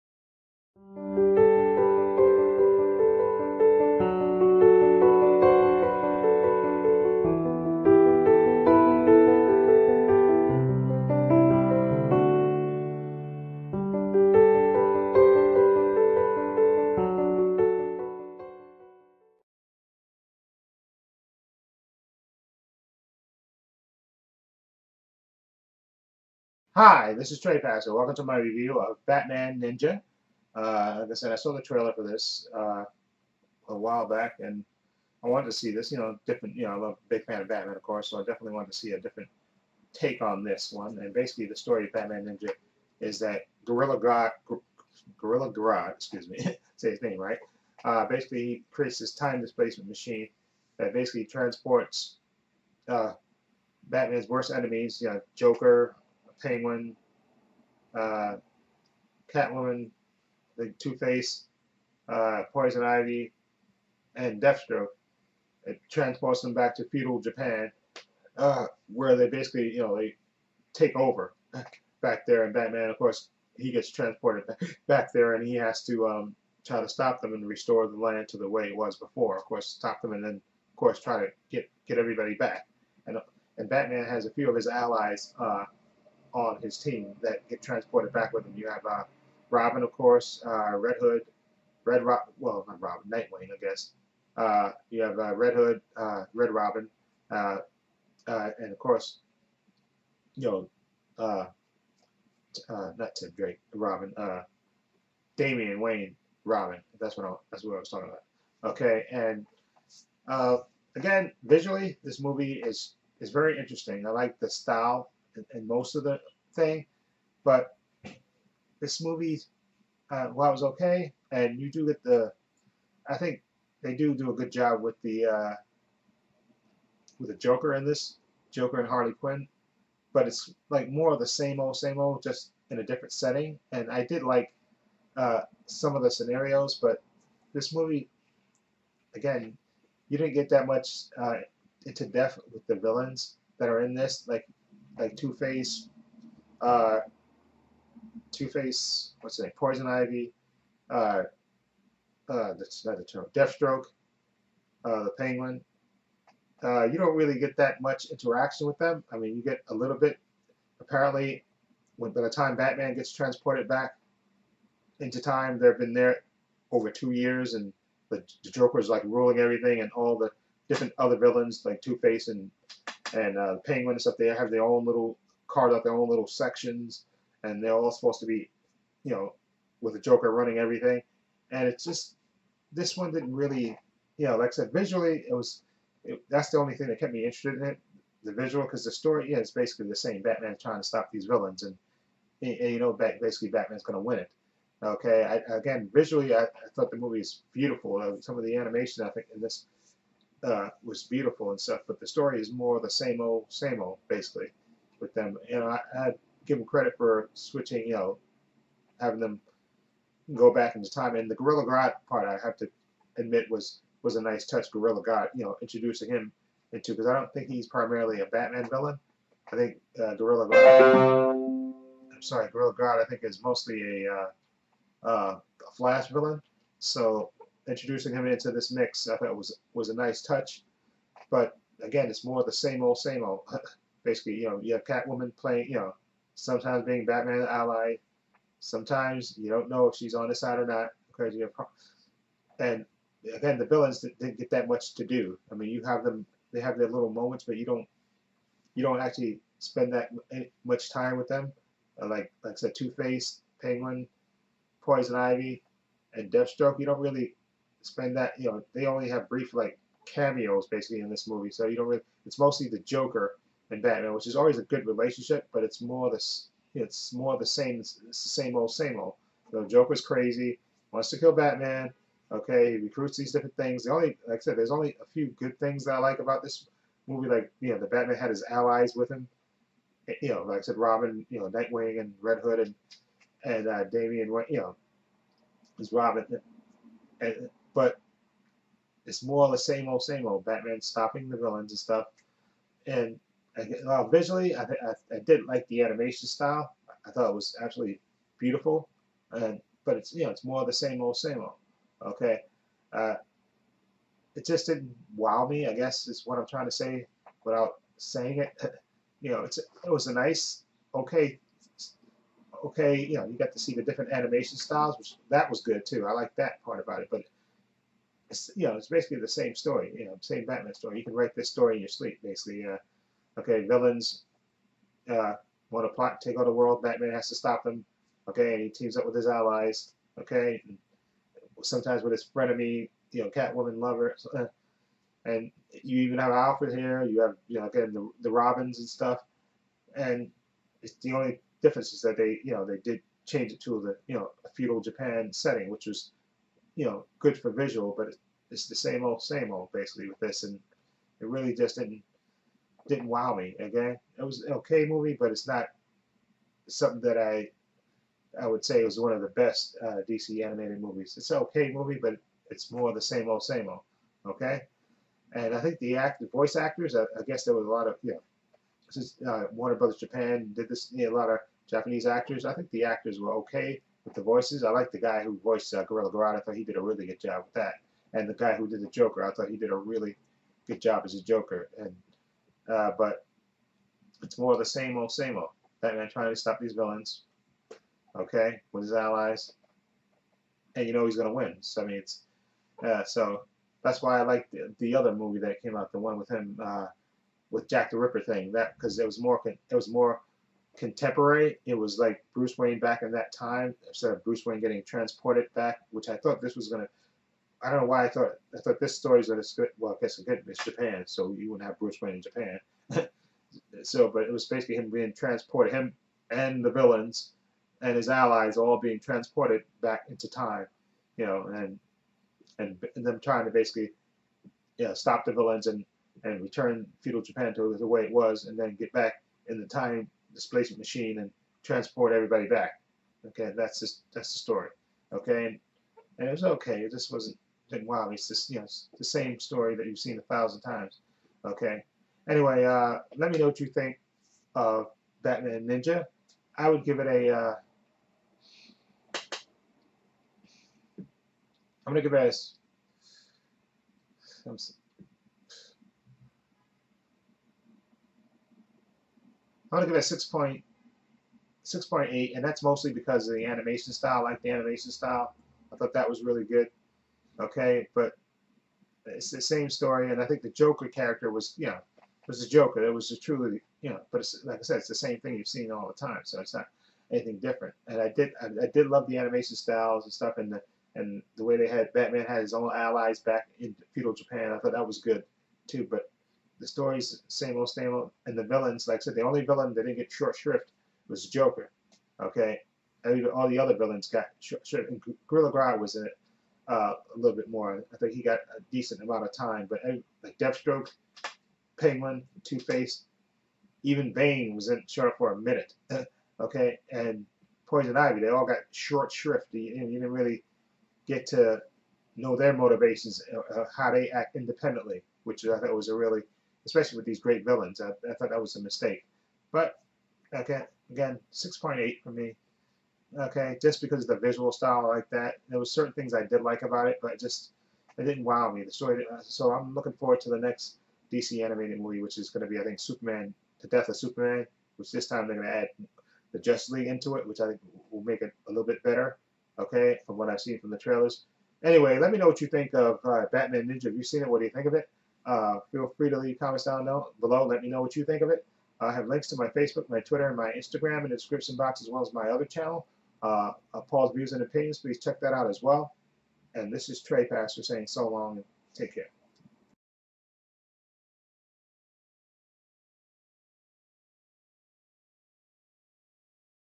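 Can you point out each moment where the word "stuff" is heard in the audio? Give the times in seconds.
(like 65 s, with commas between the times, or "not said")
174 s, 201 s, 291 s, 338 s, 480 s.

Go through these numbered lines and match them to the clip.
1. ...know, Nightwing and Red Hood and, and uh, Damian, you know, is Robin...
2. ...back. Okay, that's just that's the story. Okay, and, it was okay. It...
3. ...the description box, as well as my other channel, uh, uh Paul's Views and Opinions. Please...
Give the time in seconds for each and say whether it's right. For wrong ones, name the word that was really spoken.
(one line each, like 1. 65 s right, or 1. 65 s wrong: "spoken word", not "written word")
1. 281 s right
2. 432 s right
3. 551 s right.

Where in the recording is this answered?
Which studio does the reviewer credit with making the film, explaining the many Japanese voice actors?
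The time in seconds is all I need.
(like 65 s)
369 s.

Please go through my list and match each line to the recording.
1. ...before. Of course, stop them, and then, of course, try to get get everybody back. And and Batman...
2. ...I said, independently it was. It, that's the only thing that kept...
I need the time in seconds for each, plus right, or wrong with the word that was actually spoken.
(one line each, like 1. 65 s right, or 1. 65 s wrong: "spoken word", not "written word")
1. 78 s right
2. 184 s wrong: "visually", not "independently".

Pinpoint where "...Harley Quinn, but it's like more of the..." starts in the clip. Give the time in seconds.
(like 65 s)
128 s.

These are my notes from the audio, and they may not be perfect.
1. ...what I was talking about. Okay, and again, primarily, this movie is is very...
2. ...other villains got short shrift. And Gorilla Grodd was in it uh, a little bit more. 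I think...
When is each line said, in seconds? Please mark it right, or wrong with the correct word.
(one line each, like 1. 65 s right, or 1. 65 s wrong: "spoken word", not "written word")
1. 107 s wrong: "visually", not "primarily"
2. 493 s right.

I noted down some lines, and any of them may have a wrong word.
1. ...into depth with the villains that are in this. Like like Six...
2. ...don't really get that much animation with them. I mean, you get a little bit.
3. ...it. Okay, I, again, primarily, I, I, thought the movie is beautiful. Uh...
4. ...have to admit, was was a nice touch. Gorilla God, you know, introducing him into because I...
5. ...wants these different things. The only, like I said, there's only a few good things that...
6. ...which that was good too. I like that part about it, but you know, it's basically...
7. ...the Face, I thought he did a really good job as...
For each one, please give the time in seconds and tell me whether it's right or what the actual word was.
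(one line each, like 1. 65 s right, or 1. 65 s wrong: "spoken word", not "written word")
1. 141 s wrong: "Two", not "Six"
2. 156 s wrong: "interaction", not "animation"
3. 194 s wrong: "visually", not "primarily"
4. 212 s right
5. 272 s wrong: "recruits", not "wants"
6. 314 s right
7. 378 s wrong: "Joker", not "Face".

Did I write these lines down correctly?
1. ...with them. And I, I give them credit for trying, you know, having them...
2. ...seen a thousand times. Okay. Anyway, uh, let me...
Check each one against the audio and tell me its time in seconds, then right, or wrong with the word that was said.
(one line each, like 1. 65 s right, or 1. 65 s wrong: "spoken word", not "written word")
1. 204 s wrong: "switching", not "trying"
2. 439 s right.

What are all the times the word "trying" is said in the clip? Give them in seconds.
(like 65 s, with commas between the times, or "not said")
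190 s, 306 s, 386 s, 423 s.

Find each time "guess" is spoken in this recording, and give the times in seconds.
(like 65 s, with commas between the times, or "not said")
93 s, 305 s, 367 s, 410 s.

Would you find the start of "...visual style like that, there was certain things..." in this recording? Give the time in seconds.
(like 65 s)
524 s.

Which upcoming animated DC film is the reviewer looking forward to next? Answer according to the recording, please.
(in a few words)
The Death of Superman.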